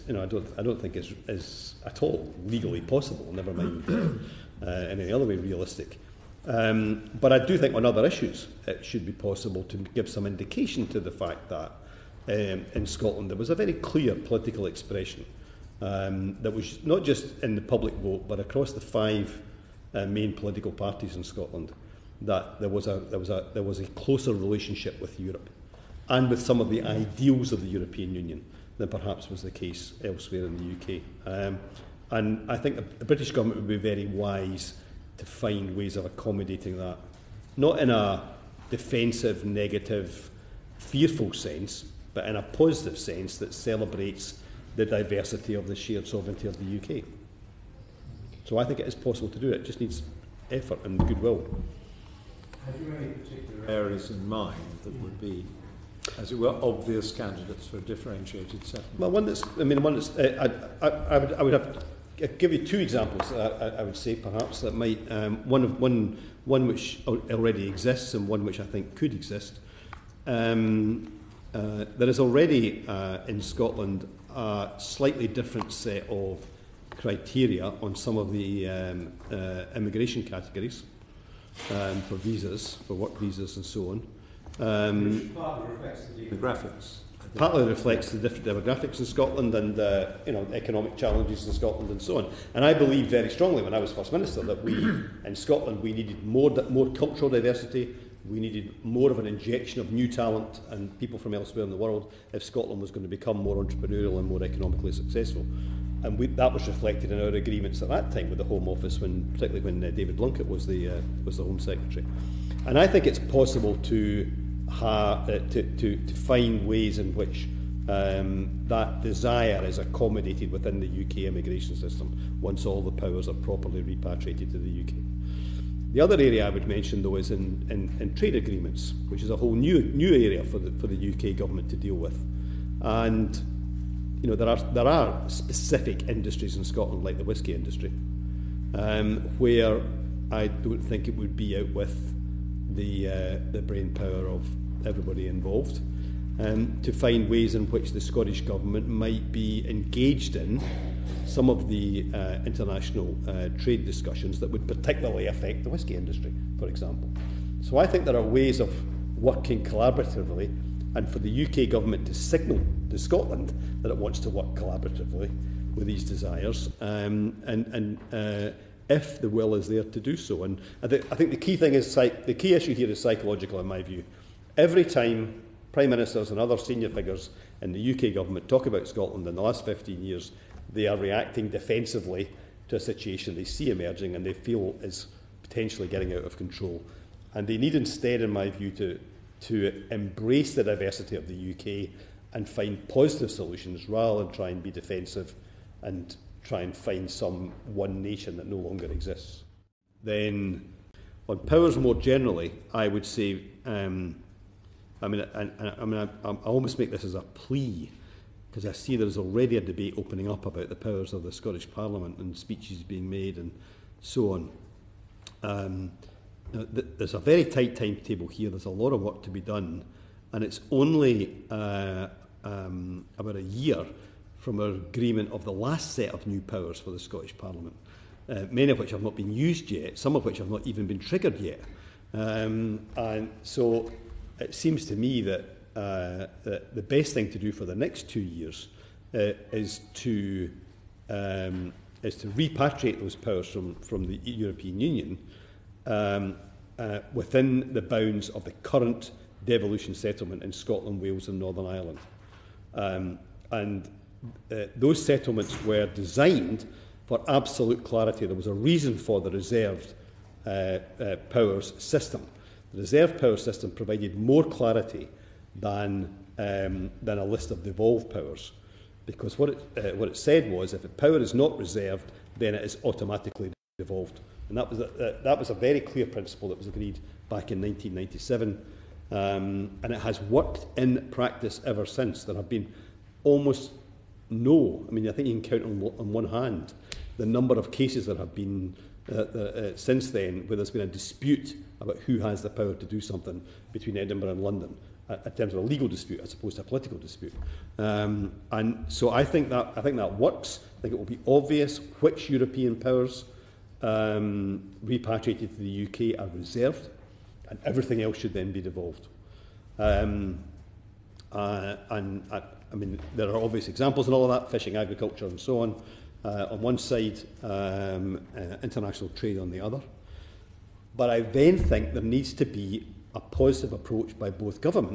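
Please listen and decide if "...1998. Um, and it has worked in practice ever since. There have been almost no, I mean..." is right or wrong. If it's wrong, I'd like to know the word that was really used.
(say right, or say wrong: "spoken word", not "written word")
wrong: "1997", not "1998".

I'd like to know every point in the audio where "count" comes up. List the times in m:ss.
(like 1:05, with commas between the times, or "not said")
4:45.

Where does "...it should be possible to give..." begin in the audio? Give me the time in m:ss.
0:08.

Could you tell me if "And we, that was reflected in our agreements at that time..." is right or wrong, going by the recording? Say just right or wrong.
right.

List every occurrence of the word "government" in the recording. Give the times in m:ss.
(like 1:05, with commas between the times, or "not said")
0:33, 2:11, 2:28, 2:41, 2:58.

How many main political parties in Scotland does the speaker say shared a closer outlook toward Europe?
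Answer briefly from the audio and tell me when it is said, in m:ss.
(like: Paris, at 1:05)
5, at 0:18.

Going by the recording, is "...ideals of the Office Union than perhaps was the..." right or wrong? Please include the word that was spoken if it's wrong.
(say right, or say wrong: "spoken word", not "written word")
wrong: "European", not "Office".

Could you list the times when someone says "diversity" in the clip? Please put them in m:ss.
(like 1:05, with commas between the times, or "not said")
0:44, 1:37, 3:10.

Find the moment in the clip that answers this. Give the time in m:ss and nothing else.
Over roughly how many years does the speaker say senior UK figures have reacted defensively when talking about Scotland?
2:59.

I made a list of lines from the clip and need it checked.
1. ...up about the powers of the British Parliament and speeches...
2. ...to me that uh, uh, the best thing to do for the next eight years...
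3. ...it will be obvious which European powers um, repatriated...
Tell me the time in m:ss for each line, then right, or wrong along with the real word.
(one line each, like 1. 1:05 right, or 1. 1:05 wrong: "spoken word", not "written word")
1. 3:30 wrong: "Scottish", not "British"
2. 3:54 wrong: "two", not "eight"
3. 5:00 right.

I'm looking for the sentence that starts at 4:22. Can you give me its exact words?
The reserved power system provided more clarity than, um, than a list of devolved powers.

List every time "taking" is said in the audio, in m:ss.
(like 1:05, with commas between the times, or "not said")
not said.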